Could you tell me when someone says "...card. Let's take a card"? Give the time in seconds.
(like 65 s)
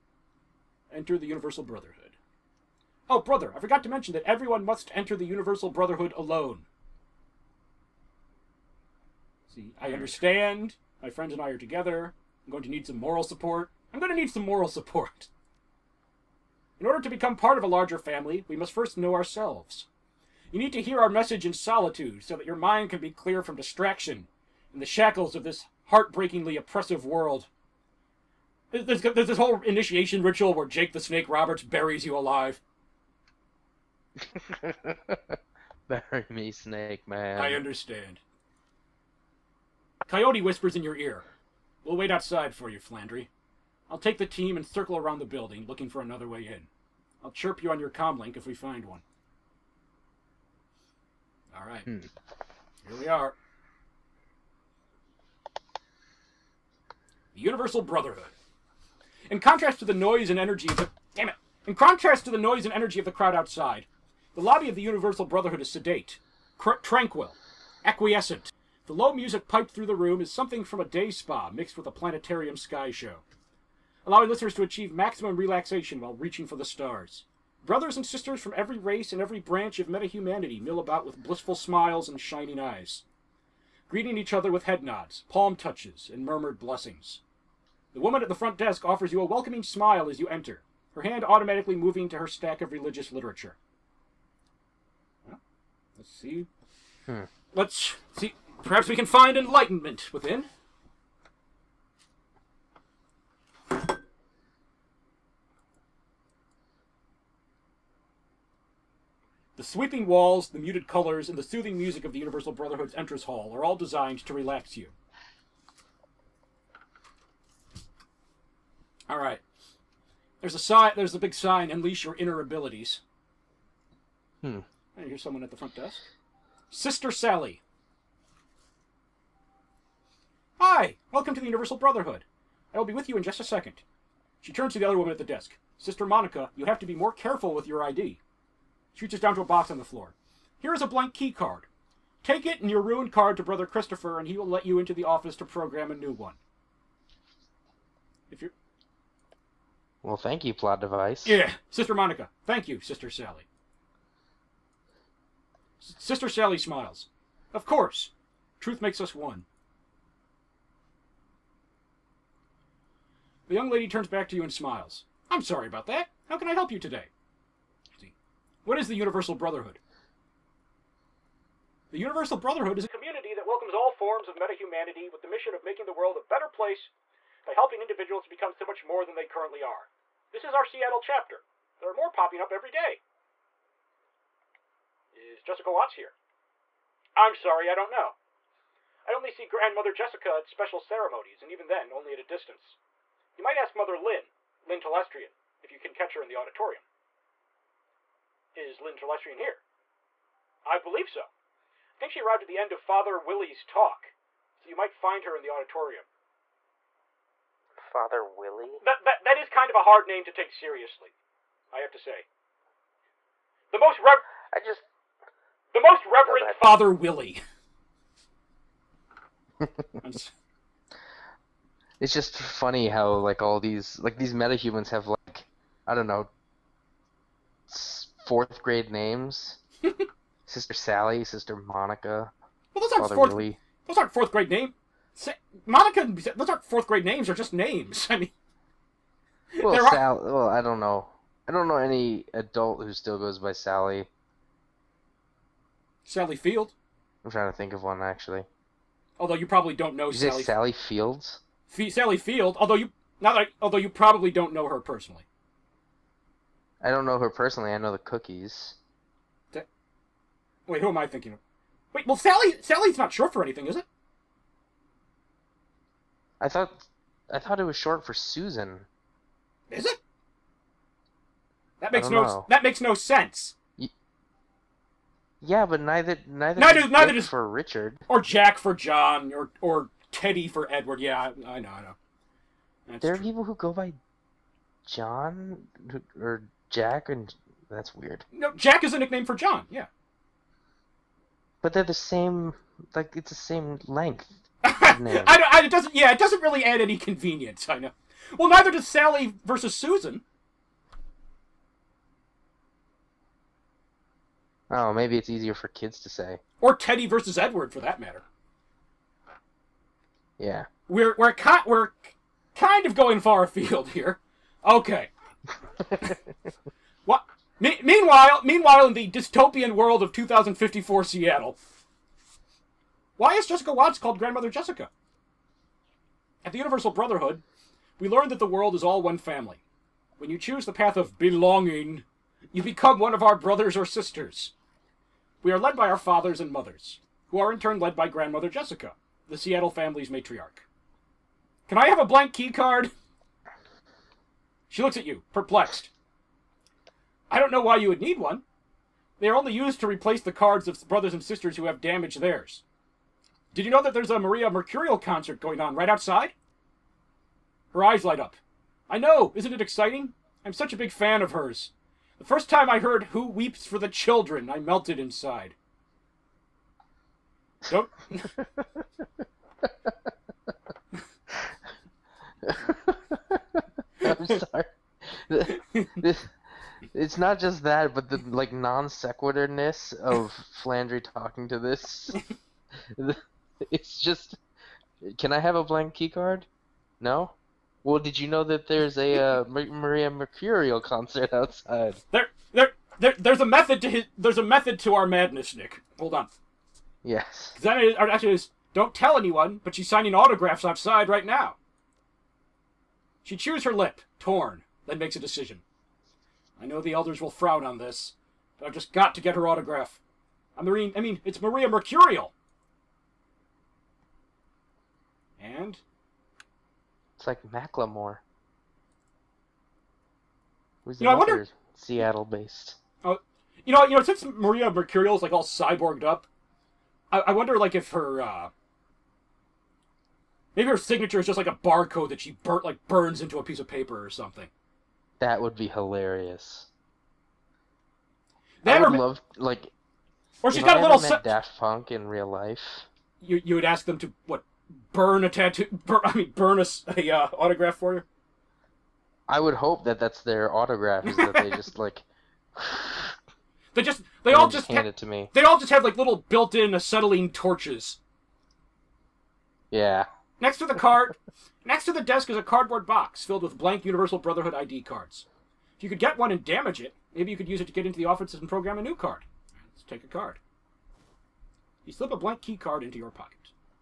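468 s.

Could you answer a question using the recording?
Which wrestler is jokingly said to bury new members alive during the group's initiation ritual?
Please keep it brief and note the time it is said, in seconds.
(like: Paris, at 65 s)
Jake the Snake Roberts, at 30 s.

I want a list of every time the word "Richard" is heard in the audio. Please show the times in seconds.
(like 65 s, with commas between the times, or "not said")
277 s.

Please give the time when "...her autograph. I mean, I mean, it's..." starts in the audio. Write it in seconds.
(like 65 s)
409 s.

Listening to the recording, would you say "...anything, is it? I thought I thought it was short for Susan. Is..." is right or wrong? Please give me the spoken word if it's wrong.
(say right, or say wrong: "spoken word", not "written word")
right.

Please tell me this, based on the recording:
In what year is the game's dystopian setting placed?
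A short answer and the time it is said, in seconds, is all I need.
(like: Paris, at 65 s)
2054, at 320 s.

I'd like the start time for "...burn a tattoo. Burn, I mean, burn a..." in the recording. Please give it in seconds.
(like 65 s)
444 s.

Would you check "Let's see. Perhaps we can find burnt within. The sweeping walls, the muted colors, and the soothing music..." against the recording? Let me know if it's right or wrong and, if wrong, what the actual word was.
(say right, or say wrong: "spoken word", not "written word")
wrong: "enlightenment", not "burnt".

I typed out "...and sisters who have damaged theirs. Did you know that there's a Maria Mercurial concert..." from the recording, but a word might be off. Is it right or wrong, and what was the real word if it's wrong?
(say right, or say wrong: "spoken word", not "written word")
right.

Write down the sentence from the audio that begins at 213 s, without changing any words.
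The most rev- I just the most Reverend Father Willie.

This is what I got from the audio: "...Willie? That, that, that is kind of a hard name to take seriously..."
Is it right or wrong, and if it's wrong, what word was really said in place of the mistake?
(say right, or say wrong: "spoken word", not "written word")
right.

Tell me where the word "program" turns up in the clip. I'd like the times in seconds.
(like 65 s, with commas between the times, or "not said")
145 s, 468 s.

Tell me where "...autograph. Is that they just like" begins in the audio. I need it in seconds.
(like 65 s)
450 s.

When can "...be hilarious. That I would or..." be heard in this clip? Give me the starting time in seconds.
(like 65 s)
435 s.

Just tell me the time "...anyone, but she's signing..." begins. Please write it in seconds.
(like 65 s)
399 s.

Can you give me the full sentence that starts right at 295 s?
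Yeah, it doesn't really add any convenience.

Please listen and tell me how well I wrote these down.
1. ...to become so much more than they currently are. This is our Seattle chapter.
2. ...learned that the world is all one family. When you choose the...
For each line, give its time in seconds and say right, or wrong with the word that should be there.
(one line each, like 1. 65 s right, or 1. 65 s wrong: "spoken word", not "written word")
1. 178 s right
2. 328 s right.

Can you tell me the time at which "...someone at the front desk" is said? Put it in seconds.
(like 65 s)
125 s.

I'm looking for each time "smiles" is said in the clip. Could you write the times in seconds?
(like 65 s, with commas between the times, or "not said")
81 s, 89 s, 156 s, 164 s.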